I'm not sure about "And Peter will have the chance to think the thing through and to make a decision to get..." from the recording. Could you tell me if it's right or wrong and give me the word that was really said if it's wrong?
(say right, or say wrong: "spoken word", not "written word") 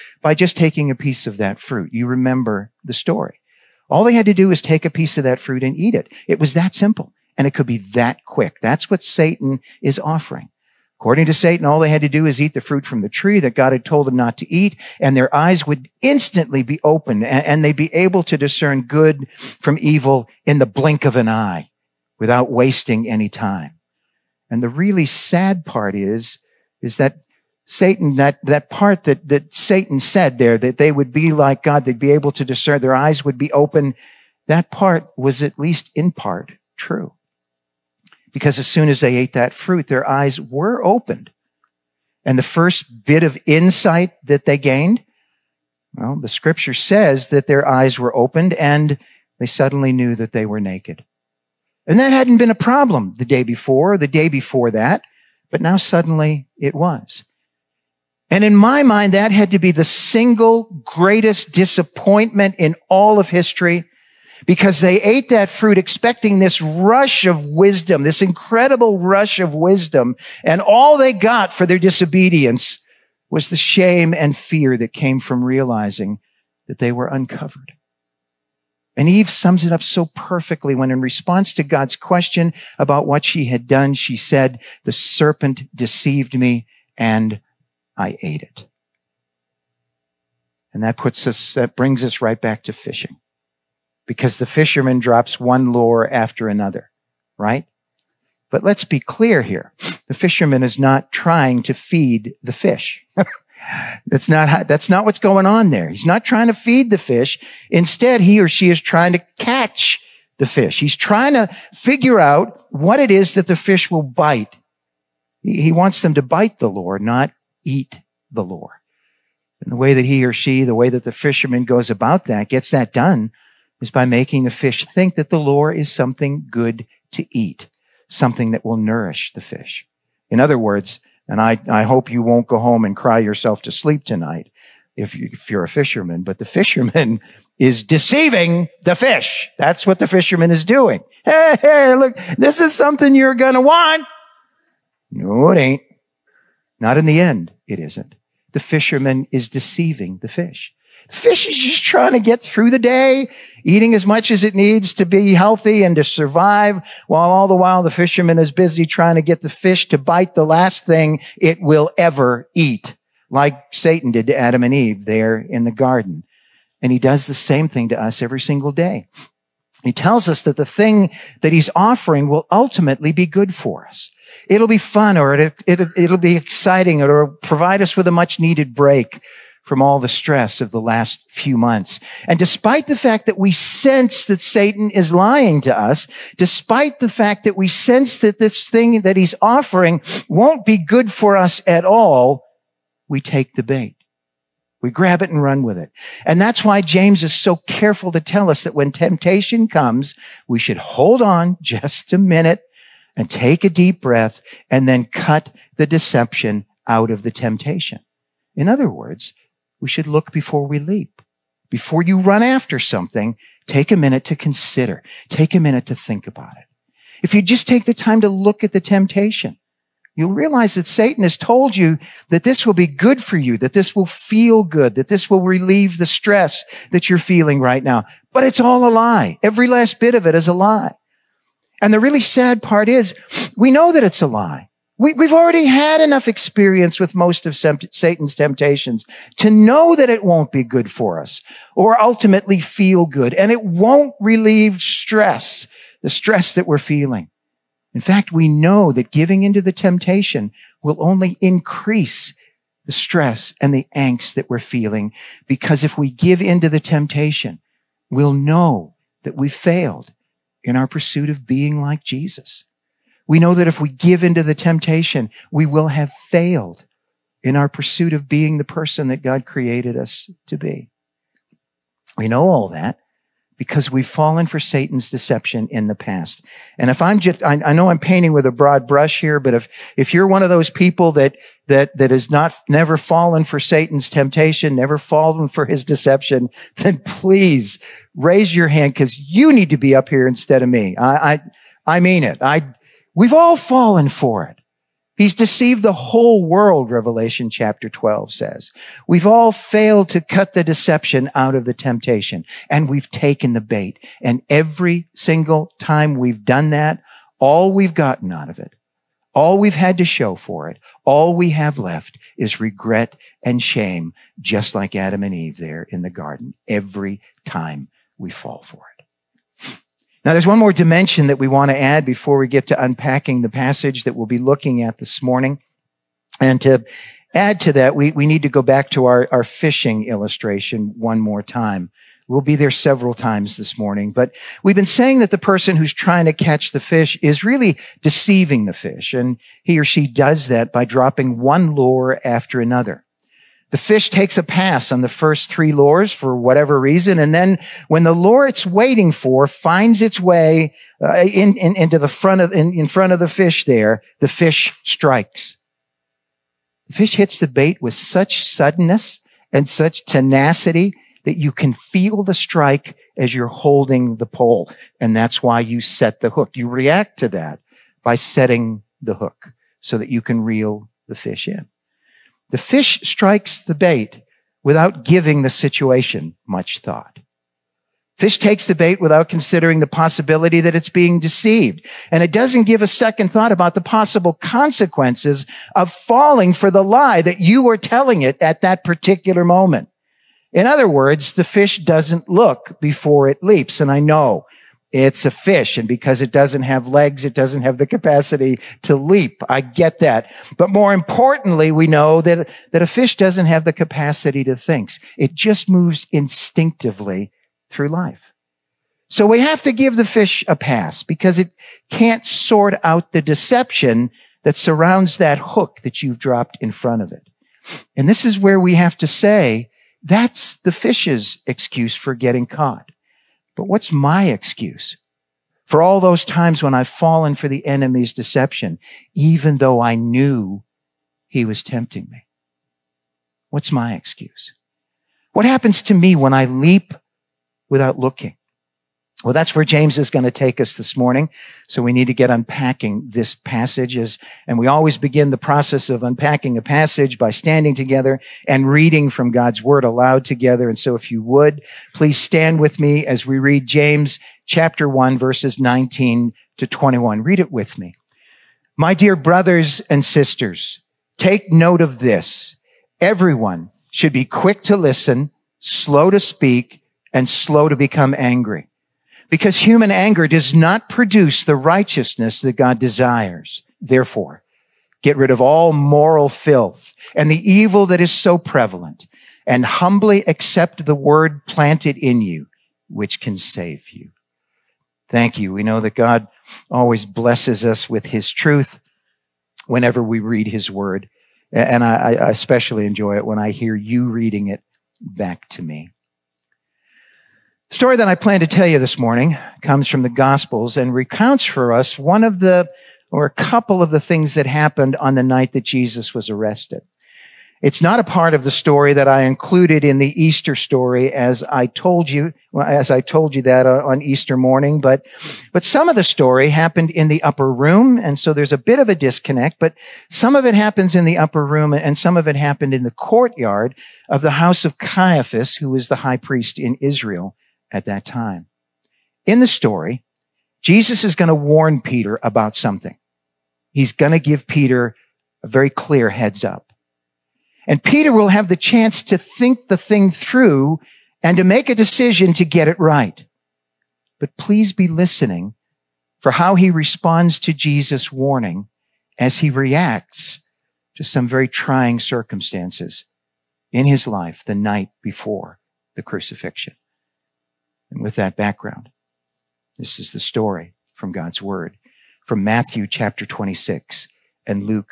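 right.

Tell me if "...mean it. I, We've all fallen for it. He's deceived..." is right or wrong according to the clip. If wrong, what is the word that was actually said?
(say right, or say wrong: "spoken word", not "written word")
right.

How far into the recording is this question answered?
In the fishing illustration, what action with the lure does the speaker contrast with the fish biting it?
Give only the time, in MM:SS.
01:56.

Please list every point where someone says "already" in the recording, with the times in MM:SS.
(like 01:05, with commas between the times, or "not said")
03:55.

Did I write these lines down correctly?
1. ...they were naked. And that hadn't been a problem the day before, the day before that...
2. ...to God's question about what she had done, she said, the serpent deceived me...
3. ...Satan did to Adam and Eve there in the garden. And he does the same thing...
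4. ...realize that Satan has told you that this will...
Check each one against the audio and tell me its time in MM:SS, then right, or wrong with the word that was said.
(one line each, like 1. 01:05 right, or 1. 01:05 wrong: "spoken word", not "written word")
1. 00:50 right
2. 01:21 right
3. 02:43 right
4. 03:40 right.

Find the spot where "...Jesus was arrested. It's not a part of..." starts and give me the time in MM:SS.
08:25.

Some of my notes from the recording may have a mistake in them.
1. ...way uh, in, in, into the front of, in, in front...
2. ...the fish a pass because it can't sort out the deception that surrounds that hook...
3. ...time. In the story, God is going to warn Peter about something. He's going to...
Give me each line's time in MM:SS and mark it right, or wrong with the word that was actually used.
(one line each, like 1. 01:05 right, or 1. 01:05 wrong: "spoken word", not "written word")
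1. 05:50 right
2. 06:49 right
3. 08:48 wrong: "Jesus", not "God".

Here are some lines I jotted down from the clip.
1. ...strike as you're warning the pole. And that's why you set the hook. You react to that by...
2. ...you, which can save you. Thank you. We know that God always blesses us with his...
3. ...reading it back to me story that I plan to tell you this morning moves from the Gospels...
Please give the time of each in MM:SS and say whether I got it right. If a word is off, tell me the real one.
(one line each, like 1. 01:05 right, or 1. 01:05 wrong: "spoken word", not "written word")
1. 06:02 wrong: "holding", not "warning"
2. 08:02 right
3. 08:14 wrong: "comes", not "moves".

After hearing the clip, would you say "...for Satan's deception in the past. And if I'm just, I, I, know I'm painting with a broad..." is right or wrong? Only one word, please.
right.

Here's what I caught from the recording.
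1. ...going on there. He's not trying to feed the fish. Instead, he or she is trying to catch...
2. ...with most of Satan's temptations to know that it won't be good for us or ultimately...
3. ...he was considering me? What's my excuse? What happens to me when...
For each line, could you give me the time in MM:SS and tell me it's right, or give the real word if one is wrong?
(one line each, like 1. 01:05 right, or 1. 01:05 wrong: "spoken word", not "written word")
1. 01:45 right
2. 03:56 right
3. 07:11 wrong: "tempting", not "considering".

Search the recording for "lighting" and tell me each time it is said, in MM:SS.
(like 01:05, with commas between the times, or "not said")
not said.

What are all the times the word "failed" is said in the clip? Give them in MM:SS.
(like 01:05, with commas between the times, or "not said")
04:19, 04:26, 04:59.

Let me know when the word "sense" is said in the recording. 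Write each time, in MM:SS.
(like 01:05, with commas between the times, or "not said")
03:03, 03:07.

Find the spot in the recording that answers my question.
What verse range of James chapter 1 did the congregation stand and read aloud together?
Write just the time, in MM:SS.
07:35.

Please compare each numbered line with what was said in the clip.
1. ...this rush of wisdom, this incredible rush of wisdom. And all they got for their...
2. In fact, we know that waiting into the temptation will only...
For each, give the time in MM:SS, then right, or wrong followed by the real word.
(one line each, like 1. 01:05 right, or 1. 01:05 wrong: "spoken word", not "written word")
1. 01:06 right
2. 04:07 wrong: "giving", not "waiting".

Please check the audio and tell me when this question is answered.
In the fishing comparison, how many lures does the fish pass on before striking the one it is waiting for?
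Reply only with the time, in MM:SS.
05:45.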